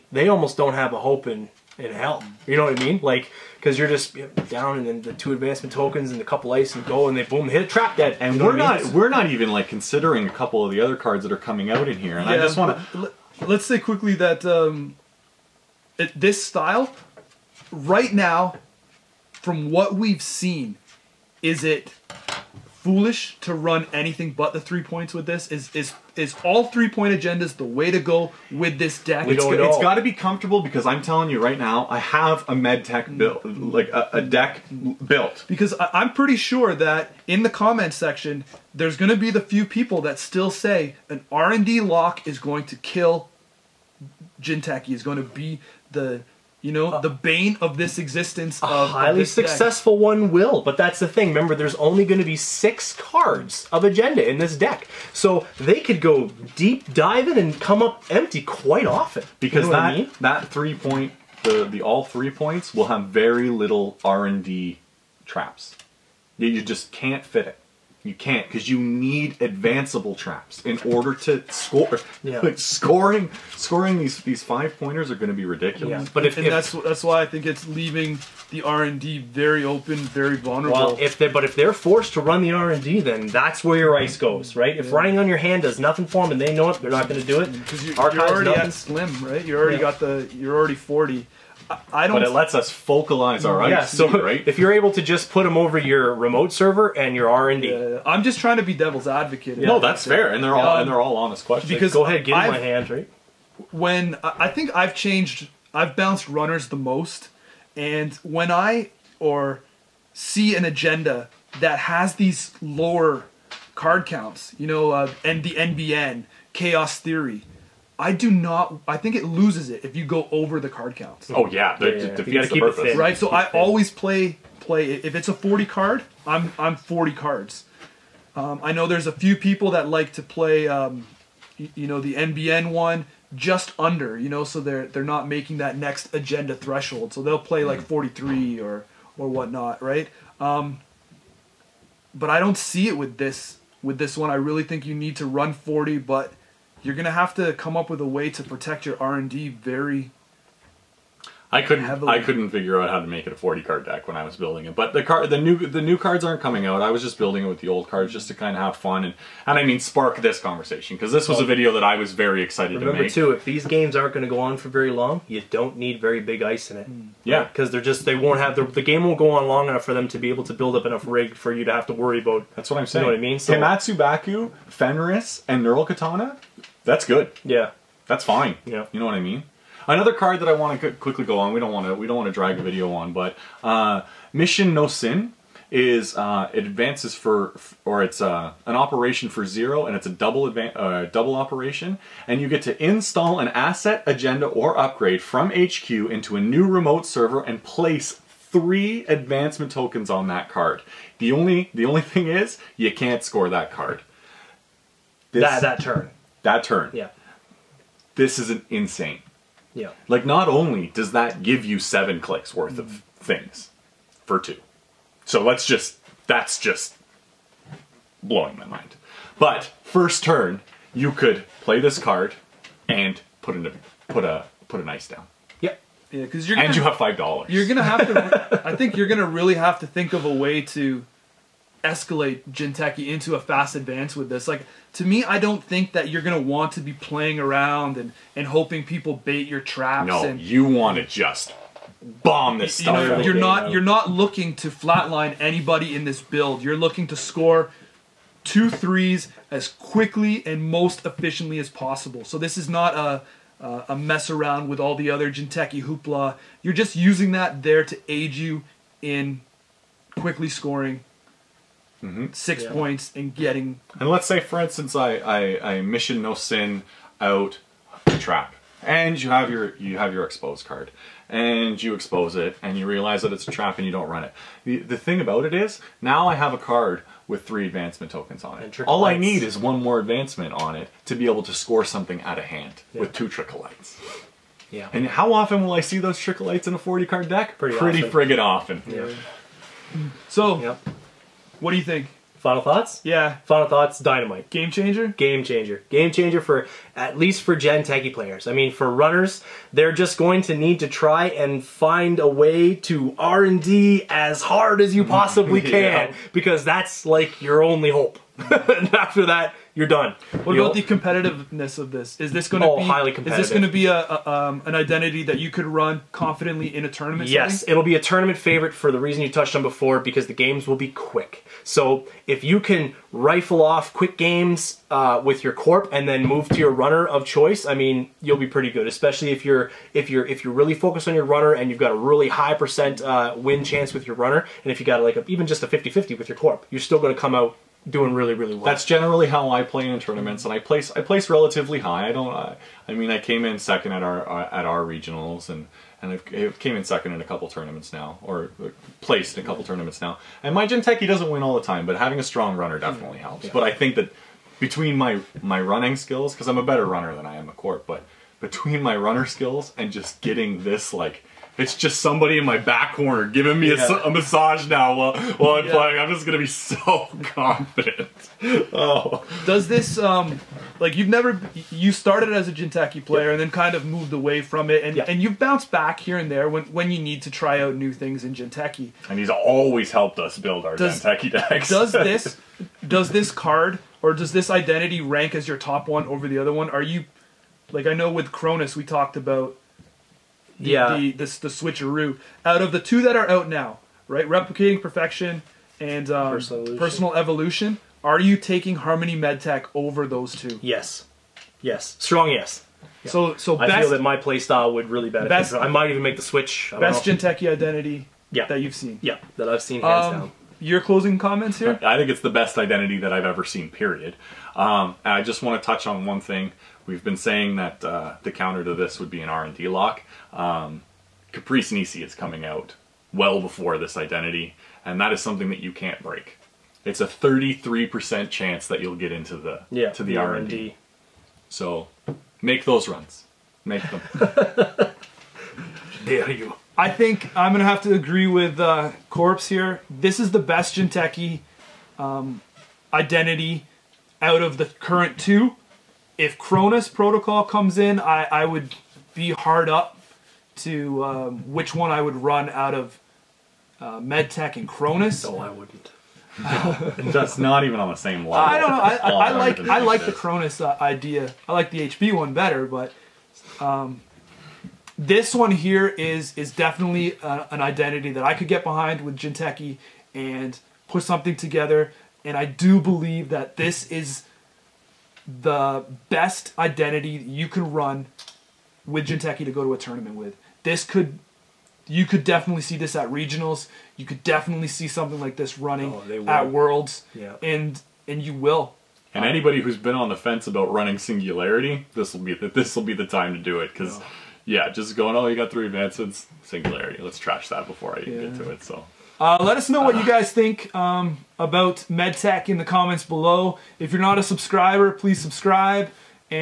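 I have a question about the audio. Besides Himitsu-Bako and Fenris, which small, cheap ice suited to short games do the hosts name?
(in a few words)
Neural Katana.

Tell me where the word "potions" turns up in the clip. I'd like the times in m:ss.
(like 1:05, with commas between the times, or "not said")
not said.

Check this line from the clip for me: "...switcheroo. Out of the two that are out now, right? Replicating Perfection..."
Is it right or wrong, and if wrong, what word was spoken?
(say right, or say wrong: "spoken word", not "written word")
right.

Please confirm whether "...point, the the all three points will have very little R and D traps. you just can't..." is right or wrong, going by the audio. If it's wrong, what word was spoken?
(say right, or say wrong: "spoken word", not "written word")
right.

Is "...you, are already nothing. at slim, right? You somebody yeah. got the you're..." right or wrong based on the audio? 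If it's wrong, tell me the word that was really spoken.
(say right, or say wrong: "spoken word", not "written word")
wrong: "already", not "somebody".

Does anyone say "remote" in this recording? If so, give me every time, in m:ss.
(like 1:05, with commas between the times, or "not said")
1:36, 3:16.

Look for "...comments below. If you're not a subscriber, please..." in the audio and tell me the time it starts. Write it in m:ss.
8:22.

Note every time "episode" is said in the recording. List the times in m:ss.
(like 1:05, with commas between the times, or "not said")
not said.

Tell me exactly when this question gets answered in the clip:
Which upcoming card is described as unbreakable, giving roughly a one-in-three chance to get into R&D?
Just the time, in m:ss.
7:01.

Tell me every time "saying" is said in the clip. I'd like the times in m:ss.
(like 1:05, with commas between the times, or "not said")
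2:52, 6:57.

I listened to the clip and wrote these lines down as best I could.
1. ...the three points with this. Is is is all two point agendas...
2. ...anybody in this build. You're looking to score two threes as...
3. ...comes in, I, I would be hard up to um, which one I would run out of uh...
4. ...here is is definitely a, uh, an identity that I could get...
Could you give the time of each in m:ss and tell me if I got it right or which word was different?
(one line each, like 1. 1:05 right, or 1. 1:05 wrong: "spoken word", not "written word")
1. 0:24 wrong: "three", not "two"
2. 4:05 right
3. 7:27 right
4. 7:45 right.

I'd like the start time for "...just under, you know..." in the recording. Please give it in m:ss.
2:13.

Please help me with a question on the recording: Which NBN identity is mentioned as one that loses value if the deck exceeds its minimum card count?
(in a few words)
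Chaos Theory.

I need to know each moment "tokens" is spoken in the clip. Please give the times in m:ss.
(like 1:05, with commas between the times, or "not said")
0:05, 3:19, 4:38.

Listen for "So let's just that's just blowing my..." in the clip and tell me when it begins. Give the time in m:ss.
3:35.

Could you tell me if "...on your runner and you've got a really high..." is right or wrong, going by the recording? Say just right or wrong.
right.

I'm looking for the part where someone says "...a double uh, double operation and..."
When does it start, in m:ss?
3:10.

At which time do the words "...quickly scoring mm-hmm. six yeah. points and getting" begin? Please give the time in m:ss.
4:20.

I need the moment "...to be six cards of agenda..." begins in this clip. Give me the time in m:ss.
0:52.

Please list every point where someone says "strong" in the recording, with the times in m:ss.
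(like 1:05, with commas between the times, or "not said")
5:52, 6:41.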